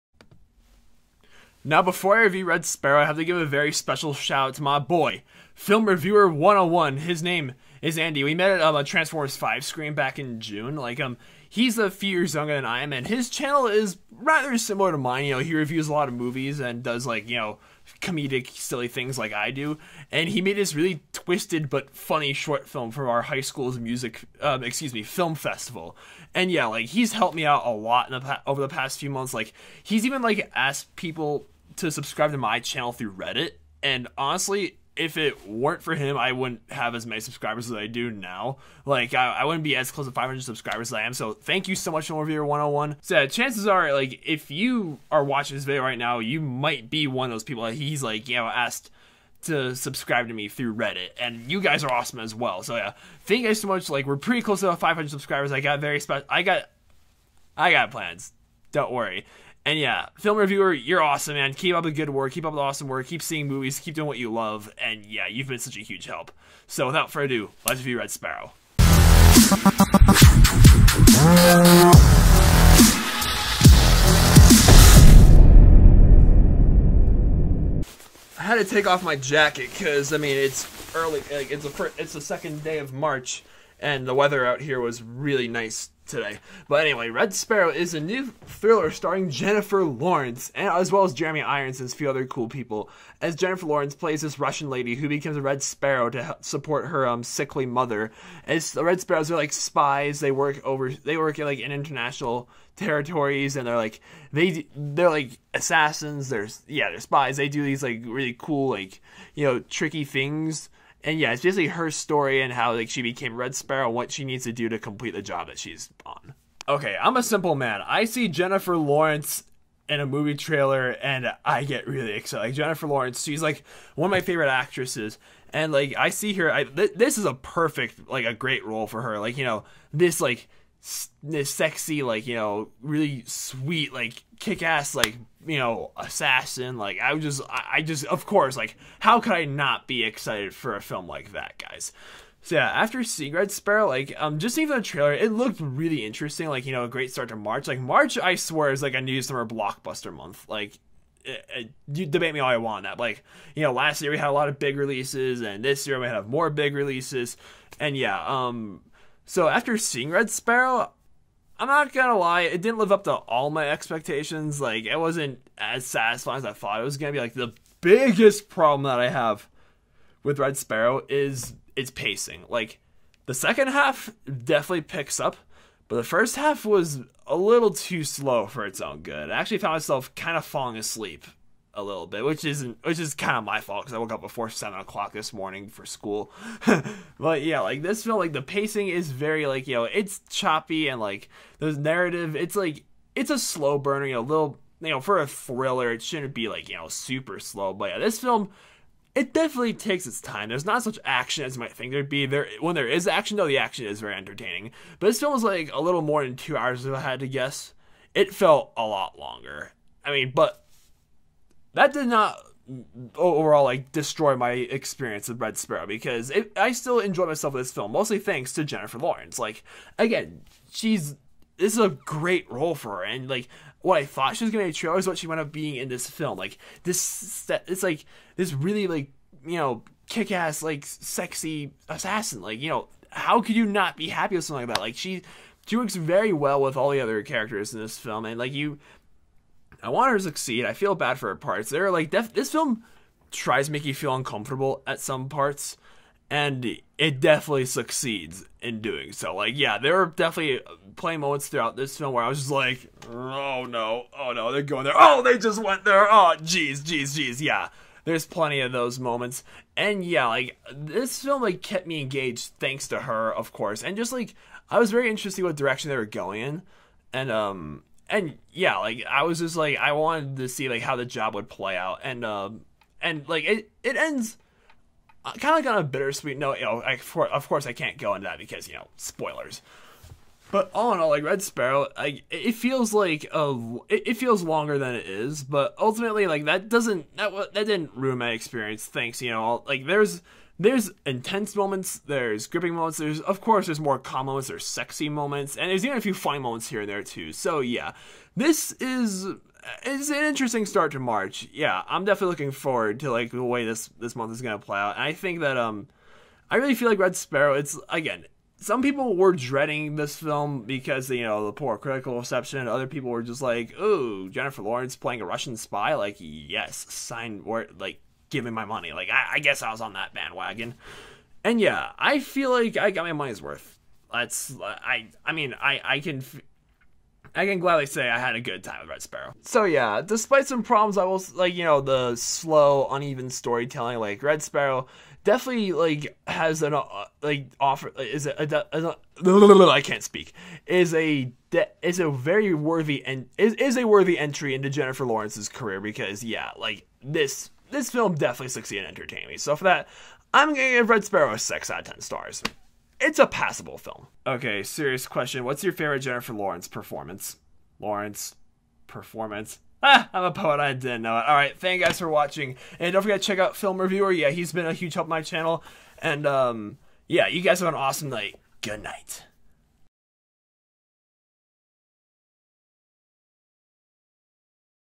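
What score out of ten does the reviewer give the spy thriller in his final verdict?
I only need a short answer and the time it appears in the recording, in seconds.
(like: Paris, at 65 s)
6, at 351 s.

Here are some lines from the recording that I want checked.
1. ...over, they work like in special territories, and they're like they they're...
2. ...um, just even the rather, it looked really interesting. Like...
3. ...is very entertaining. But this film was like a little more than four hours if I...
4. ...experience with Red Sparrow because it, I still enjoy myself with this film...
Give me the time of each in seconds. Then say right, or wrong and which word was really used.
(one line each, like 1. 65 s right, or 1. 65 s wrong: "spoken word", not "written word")
1. 100 s wrong: "international", not "special"
2. 144 s wrong: "trailer", not "rather"
3. 203 s wrong: "two", not "four"
4. 214 s right.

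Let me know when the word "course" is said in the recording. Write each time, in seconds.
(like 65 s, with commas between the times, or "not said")
138 s, 263 s, 277 s, 293 s.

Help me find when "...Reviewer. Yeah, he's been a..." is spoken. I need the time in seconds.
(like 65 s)
363 s.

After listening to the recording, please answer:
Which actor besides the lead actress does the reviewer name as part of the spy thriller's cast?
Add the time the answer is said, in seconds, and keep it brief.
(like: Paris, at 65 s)
Jeremy Irons, at 91 s.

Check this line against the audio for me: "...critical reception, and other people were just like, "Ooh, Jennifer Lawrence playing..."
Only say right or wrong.
right.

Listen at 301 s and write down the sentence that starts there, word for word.
Yeah, I'm definitely looking forward to like the way this this month is gonna play out.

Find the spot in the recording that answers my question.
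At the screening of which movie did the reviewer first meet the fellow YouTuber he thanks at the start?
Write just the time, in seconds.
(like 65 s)
8 s.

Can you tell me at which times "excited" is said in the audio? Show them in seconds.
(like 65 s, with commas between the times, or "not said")
122 s, 140 s.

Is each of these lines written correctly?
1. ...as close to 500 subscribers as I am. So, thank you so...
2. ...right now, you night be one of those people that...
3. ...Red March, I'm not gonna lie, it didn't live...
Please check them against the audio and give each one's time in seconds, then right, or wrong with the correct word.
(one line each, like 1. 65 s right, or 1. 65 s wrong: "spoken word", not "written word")
1. 39 s right
2. 45 s wrong: "might", not "night"
3. 160 s wrong: "Sparrow", not "March".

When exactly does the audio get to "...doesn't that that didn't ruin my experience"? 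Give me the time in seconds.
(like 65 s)
286 s.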